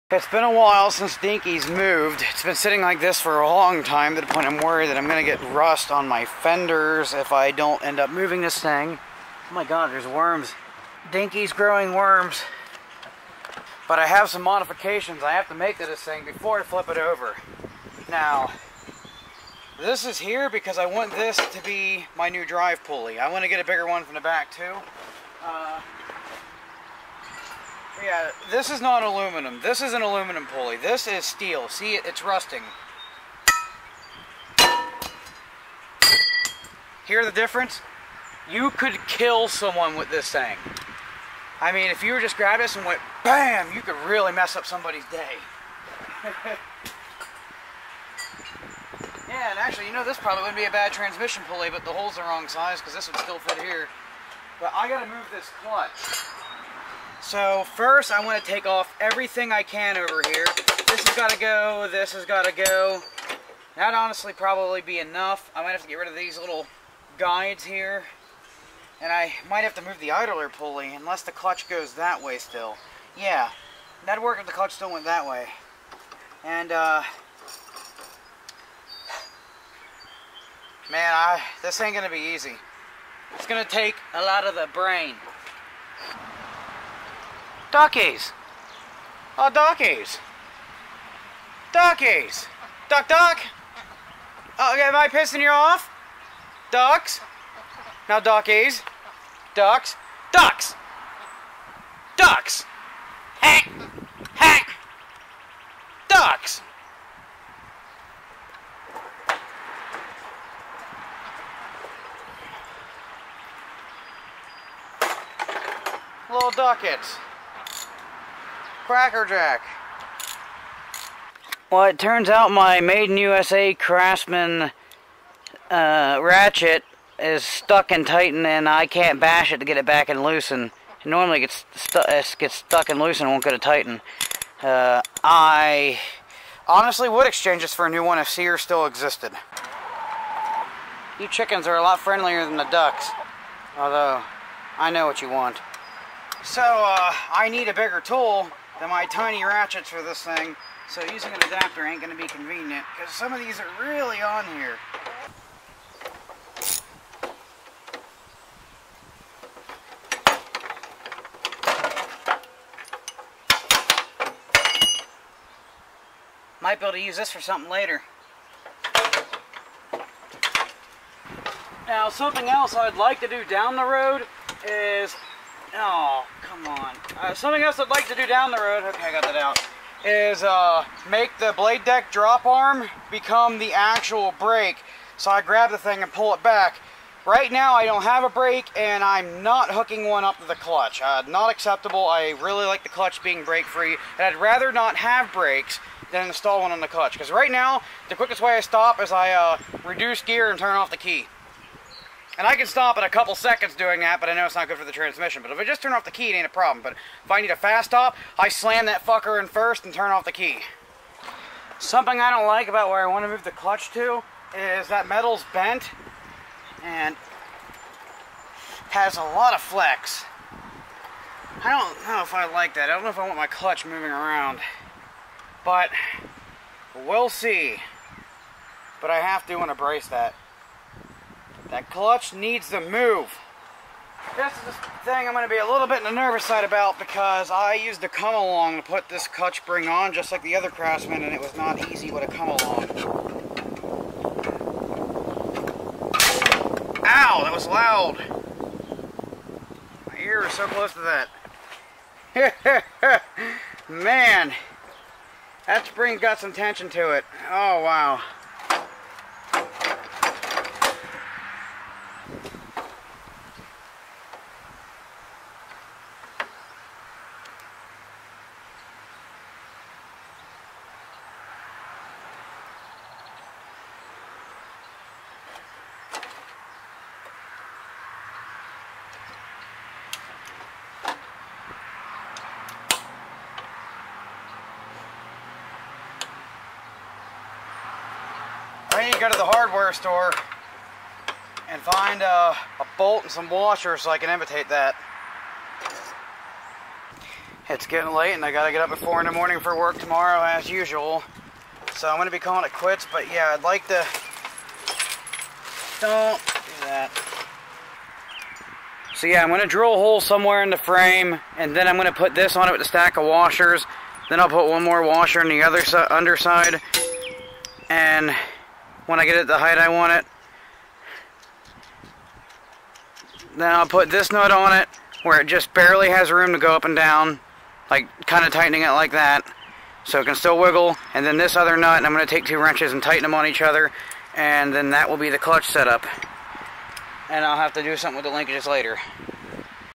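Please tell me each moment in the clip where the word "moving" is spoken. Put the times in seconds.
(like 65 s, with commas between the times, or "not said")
8 s, 223 s.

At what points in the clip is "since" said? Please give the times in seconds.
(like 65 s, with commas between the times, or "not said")
0 s.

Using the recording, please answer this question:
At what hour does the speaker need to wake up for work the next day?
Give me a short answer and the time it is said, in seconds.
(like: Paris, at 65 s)
4 in the morning, at 298 s.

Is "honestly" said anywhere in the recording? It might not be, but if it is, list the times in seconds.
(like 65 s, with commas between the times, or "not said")
63 s, 136 s.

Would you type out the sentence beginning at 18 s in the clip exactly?
Now, this is here because I want this to be my new drive pulley.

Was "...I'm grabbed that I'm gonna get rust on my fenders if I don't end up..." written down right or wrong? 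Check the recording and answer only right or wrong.
wrong.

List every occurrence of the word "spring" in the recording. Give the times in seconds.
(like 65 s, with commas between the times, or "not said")
239 s, 255 s.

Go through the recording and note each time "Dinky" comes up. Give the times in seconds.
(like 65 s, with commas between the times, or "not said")
1 s, 11 s.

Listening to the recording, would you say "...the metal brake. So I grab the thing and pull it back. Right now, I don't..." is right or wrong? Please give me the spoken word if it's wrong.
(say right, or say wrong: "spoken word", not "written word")
wrong: "actual", not "metal".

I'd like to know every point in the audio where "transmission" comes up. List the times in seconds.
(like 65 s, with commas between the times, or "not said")
50 s, 204 s.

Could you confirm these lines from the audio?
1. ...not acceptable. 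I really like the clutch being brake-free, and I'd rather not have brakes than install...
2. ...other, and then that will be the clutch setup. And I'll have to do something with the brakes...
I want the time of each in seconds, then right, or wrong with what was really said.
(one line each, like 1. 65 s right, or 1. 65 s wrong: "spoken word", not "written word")
1. 191 s right
2. 333 s wrong: "linkages", not "brakes".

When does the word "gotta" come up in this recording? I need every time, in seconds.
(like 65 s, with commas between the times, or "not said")
54 s, 298 s.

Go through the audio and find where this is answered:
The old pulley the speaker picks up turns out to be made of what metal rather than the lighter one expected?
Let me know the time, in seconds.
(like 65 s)
30 s.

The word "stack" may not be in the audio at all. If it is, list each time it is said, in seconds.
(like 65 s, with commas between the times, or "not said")
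312 s.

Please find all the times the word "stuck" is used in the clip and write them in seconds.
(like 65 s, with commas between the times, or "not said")
127 s, 132 s.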